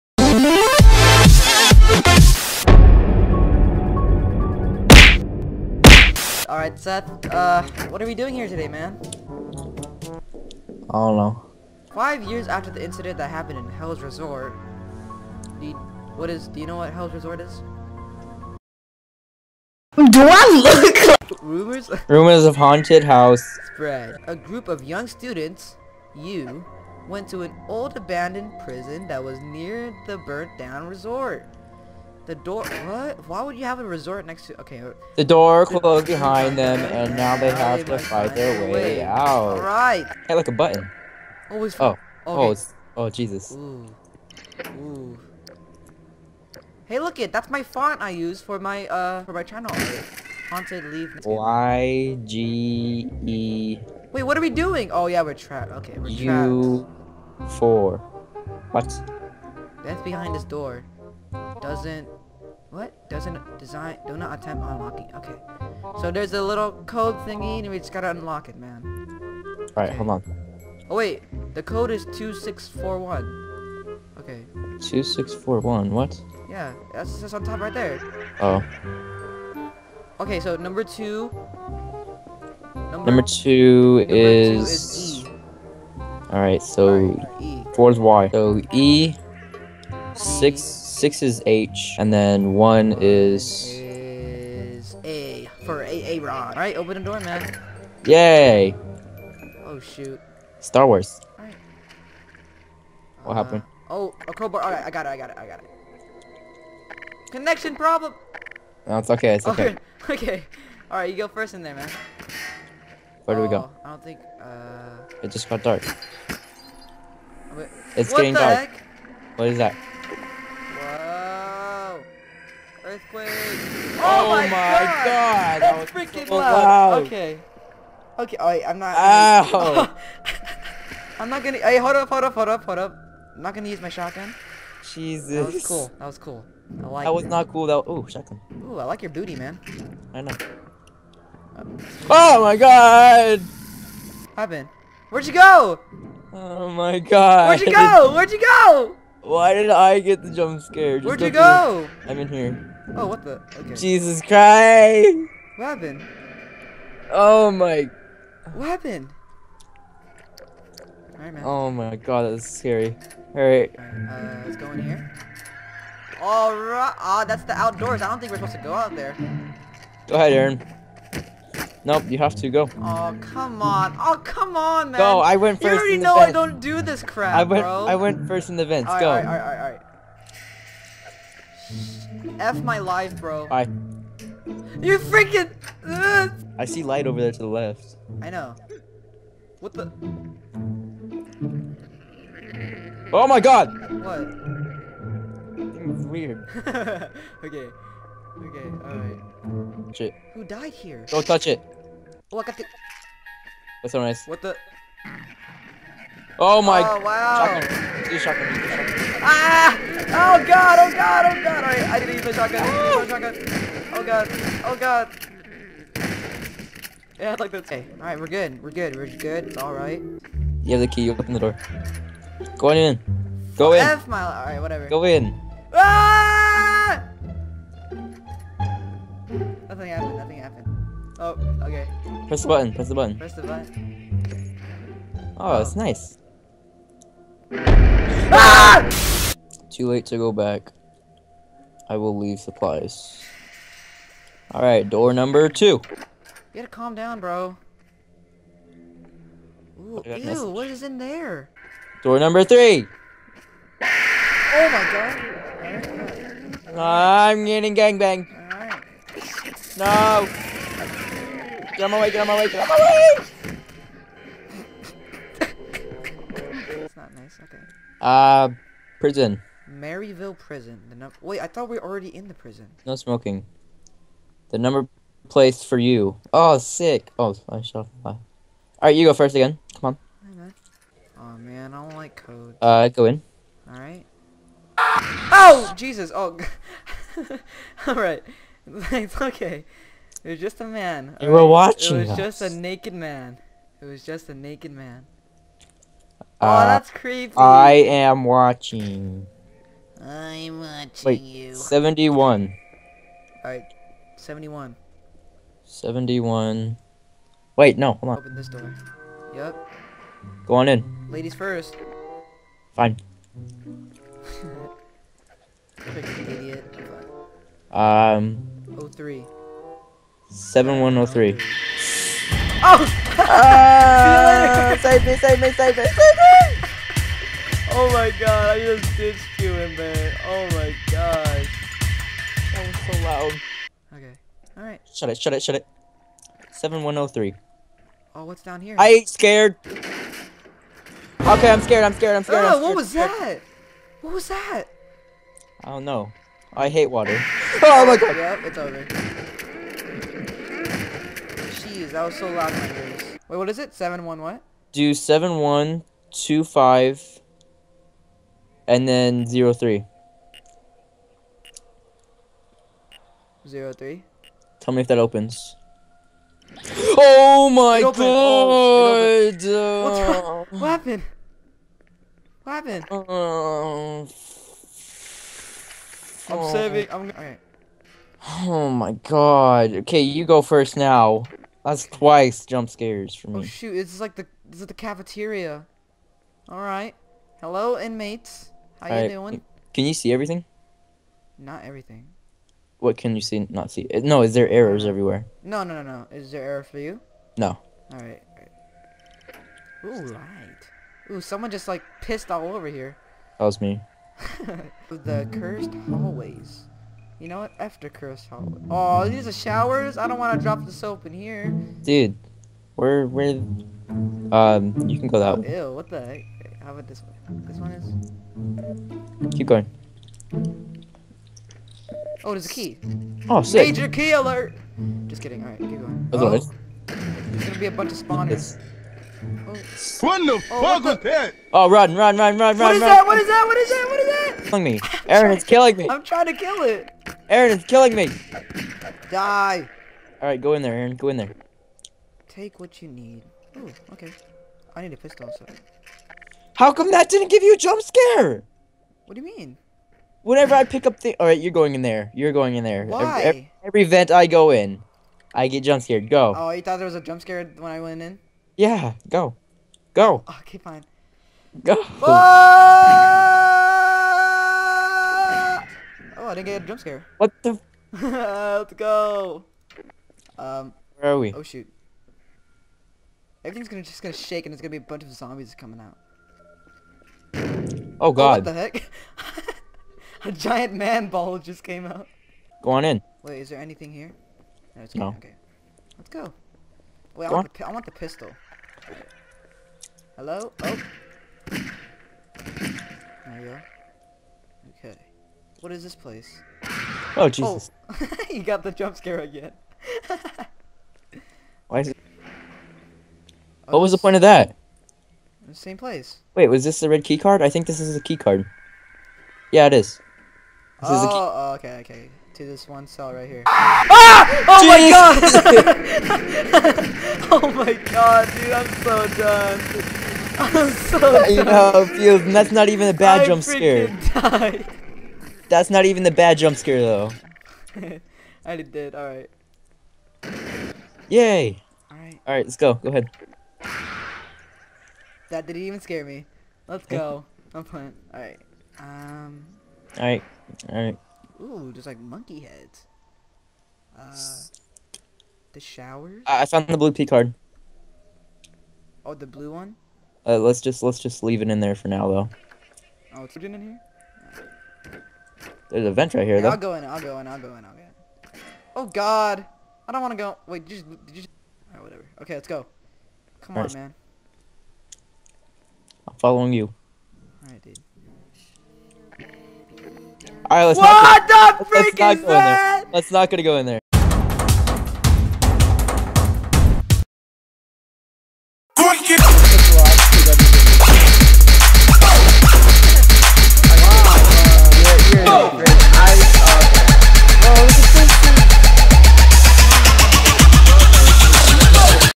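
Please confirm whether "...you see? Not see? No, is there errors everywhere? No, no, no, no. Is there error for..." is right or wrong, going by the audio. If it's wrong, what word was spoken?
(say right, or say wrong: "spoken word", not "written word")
right.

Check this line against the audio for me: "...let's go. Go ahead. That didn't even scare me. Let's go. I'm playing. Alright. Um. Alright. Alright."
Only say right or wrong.
right.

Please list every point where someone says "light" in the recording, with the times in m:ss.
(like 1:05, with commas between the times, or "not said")
3:06, 6:40.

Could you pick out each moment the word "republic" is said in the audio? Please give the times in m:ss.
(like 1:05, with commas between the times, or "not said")
not said.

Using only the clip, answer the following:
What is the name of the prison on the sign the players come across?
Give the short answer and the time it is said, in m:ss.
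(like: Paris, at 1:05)
Maryville Prison, at 4:29.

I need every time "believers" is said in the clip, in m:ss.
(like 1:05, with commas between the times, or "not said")
not said.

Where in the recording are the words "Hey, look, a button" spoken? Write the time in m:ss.
0:40.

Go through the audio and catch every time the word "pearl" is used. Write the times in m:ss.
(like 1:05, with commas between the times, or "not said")
not said.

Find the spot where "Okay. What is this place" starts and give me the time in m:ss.
8:14.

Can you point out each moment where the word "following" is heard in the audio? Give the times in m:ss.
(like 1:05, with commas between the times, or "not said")
9:26.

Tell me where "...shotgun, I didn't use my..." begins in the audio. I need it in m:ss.
3:32.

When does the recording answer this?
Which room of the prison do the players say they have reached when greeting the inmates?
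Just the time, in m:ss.
6:24.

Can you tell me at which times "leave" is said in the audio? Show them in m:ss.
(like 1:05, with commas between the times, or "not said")
4:02, 9:11.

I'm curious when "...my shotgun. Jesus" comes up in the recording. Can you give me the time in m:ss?
2:13.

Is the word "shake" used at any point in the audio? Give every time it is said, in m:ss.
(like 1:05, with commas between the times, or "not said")
7:54.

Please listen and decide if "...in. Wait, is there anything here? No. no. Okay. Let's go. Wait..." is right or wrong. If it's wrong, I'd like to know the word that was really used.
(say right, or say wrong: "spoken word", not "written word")
right.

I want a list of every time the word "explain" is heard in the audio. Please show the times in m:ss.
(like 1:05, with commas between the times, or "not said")
not said.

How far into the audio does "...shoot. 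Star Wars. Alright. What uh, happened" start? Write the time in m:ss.
1:39.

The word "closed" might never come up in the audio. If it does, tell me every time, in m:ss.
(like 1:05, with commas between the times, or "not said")
0:35.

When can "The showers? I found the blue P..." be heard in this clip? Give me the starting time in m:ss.
9:05.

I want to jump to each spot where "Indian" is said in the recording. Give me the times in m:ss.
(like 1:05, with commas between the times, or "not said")
not said.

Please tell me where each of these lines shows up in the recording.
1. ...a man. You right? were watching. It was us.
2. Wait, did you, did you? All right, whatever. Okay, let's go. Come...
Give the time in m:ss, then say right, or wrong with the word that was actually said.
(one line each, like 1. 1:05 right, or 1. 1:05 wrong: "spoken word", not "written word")
1. 4:50 right
2. 9:20 right.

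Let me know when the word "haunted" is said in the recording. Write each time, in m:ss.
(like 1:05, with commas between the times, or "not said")
0:22, 0:50.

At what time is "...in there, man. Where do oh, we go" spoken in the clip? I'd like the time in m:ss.
1:51.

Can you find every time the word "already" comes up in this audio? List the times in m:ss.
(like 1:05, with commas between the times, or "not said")
2:55, 4:31.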